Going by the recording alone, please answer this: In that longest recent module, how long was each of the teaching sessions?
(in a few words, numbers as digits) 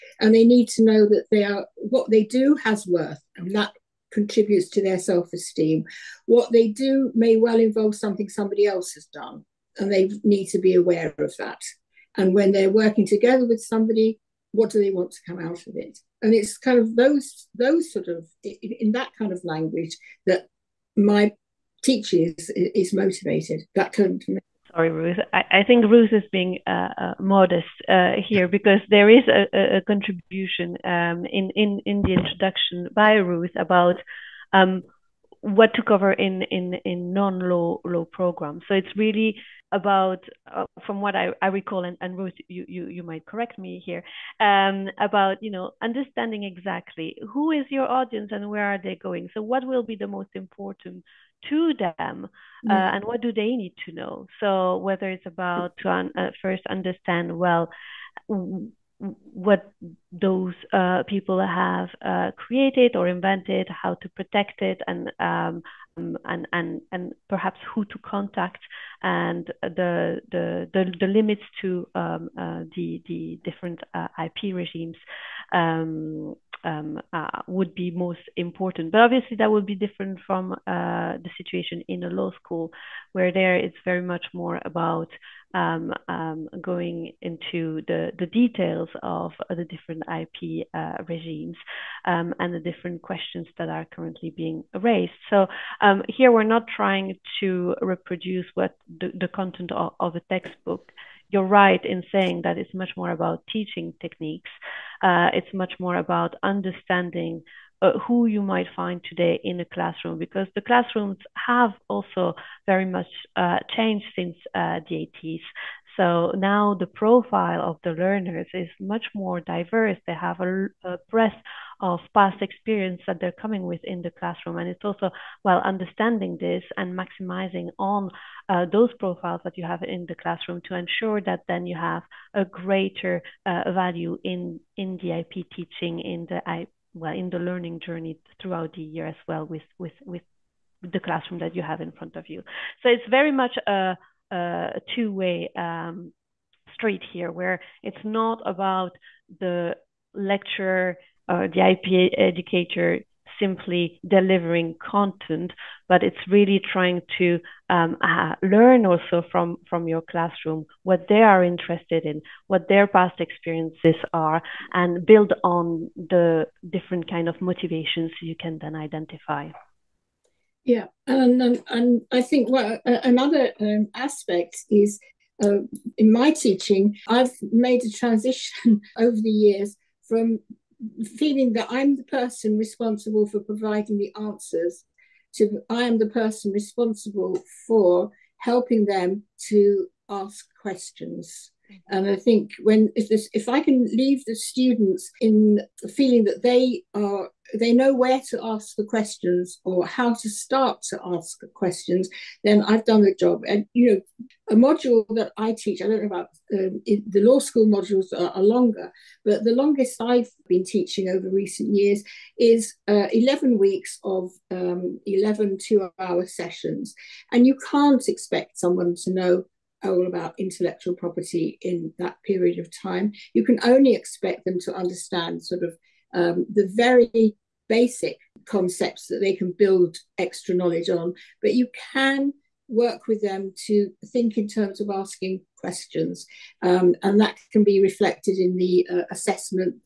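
2 hours.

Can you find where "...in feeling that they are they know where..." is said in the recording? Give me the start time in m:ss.
3:15.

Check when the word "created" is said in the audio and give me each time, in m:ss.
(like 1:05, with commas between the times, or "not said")
1:02.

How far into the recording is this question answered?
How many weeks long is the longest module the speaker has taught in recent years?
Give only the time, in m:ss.
3:33.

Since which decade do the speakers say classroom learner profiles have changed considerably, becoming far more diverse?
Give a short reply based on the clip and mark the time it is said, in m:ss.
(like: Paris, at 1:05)
the 80s, at 1:54.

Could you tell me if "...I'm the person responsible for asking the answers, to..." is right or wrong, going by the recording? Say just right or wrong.
wrong.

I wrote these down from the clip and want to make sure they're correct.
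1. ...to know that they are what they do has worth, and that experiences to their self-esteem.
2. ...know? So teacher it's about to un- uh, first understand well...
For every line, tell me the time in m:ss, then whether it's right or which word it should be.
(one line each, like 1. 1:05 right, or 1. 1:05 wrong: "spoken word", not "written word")
1. 0:00 wrong: "contributes", not "experiences"
2. 0:53 wrong: "whether", not "teacher".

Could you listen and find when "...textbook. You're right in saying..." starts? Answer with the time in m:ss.
1:40.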